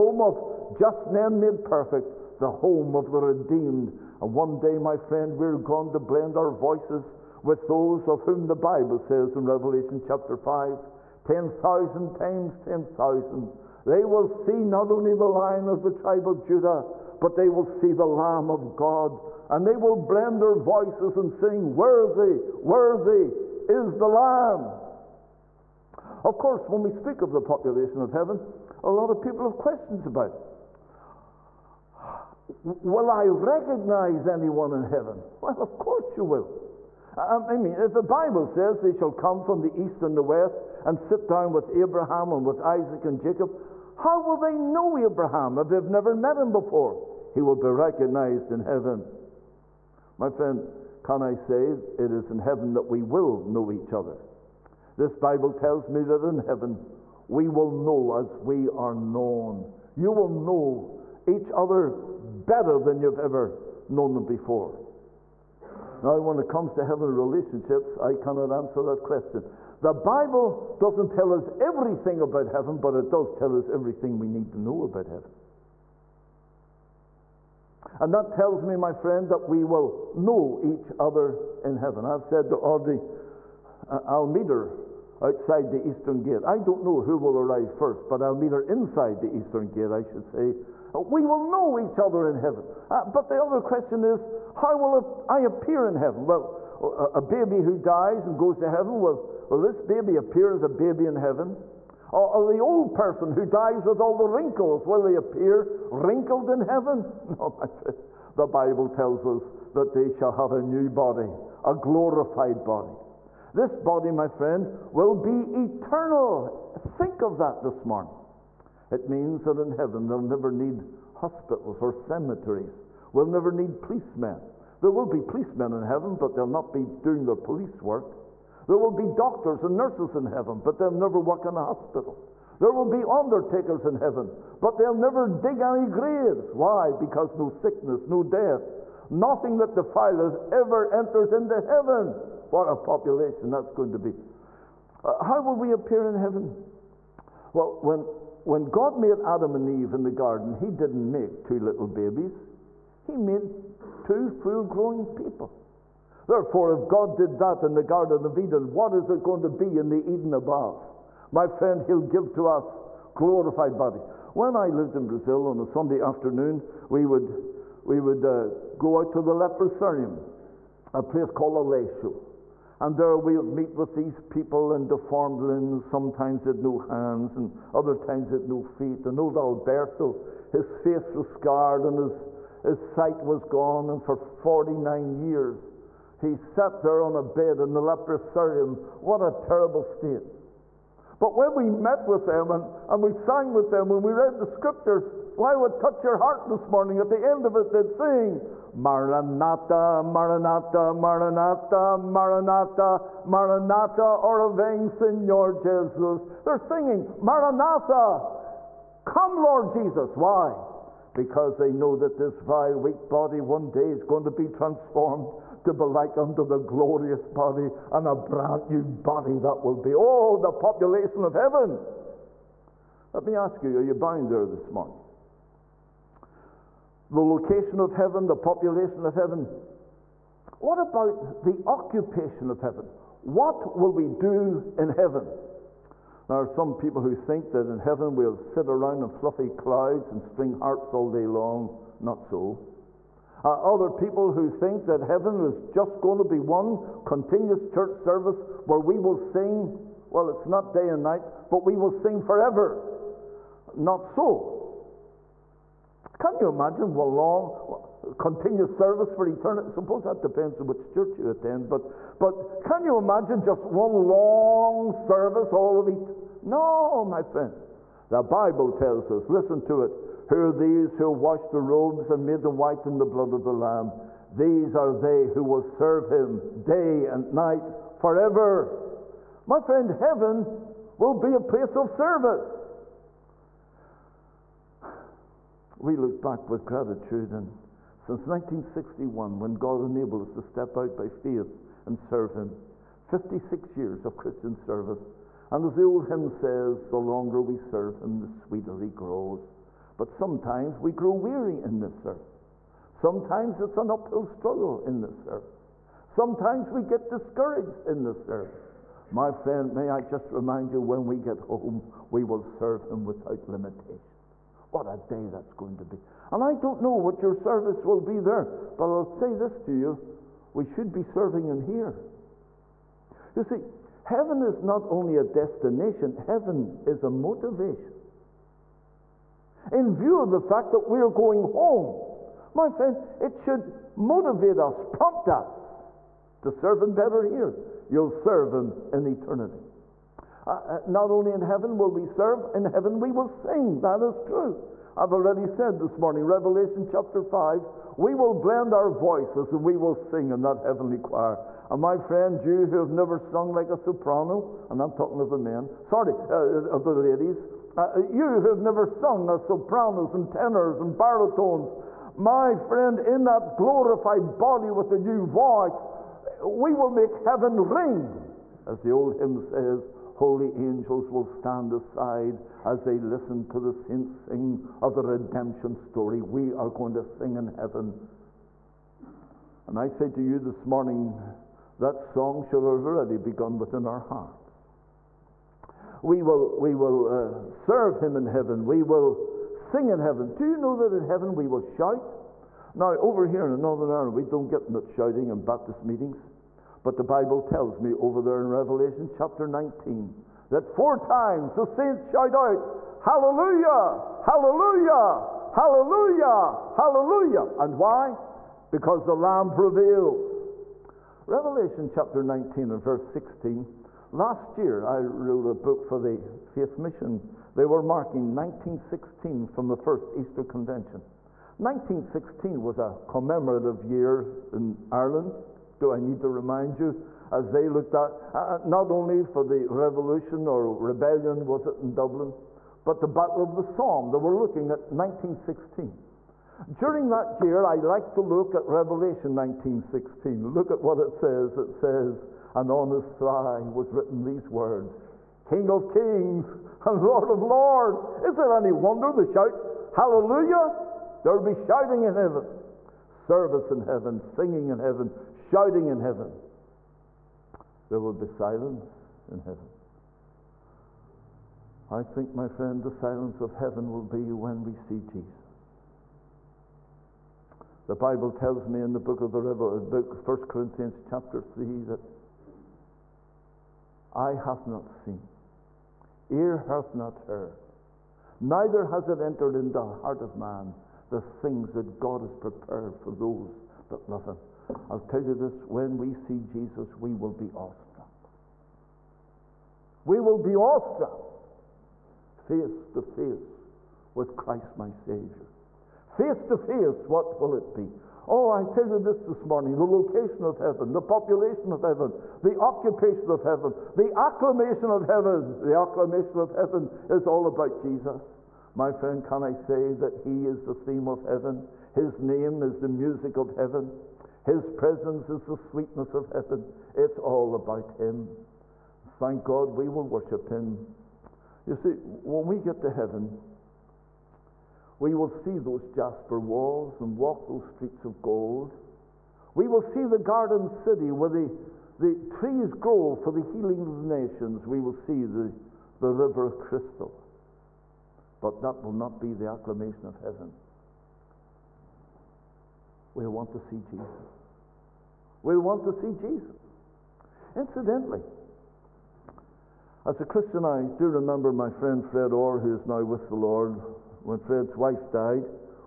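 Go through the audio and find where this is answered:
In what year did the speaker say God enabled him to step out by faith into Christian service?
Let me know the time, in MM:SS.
04:48.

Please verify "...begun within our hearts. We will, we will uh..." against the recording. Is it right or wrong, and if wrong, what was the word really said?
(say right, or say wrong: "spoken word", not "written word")
right.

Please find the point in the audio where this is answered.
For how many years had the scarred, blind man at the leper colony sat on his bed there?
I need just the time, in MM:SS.
03:04.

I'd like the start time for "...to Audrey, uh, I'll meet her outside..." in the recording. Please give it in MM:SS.
01:22.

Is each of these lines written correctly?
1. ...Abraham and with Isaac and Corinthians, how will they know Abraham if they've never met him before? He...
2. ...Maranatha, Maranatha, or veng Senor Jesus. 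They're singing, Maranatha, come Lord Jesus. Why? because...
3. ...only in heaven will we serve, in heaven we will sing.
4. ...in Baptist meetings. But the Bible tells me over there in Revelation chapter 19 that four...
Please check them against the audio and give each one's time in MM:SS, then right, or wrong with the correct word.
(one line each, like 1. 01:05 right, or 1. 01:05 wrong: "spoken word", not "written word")
1. 00:41 wrong: "Jacob", not "Corinthians"
2. 03:21 right
3. 05:41 right
4. 06:35 right.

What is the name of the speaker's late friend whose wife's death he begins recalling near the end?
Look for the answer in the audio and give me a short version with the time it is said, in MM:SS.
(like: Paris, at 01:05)
Fred Orr, at 09:12.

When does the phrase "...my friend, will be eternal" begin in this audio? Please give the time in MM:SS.
01:54.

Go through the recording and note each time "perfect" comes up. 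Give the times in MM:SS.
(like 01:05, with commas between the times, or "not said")
00:01.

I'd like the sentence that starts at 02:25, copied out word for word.
Uh, how will we appear in heaven?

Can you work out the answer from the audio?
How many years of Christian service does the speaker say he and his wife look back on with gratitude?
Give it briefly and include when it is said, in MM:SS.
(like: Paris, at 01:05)
56, at 04:53.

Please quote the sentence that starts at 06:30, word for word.
Do you know that in heaven we will shout?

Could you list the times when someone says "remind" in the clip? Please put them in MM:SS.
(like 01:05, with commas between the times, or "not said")
05:10, 07:06.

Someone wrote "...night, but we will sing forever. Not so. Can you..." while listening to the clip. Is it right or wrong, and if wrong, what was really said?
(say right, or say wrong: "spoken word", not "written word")
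right.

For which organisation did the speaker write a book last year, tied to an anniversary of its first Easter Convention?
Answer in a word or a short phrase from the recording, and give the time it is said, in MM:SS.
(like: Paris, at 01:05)
Faith Mission, at 06:56.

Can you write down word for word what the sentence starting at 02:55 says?
Sometimes they had no hands, and other times they had no feet.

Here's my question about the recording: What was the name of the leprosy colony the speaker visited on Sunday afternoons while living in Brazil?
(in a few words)
Aleixo.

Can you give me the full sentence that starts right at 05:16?
And I don't know what your service will be there, but I'll say this to you we should be serving Him here.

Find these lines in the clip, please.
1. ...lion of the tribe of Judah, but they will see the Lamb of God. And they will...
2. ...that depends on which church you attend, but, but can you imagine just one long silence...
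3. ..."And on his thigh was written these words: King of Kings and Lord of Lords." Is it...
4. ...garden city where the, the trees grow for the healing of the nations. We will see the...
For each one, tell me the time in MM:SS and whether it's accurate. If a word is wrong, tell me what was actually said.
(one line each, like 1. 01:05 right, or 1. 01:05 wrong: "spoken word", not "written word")
1. 00:15 right
2. 04:20 wrong: "service", not "silence"
3. 07:22 right
4. 08:50 right.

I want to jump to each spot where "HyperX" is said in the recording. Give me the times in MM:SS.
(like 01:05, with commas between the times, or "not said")
not said.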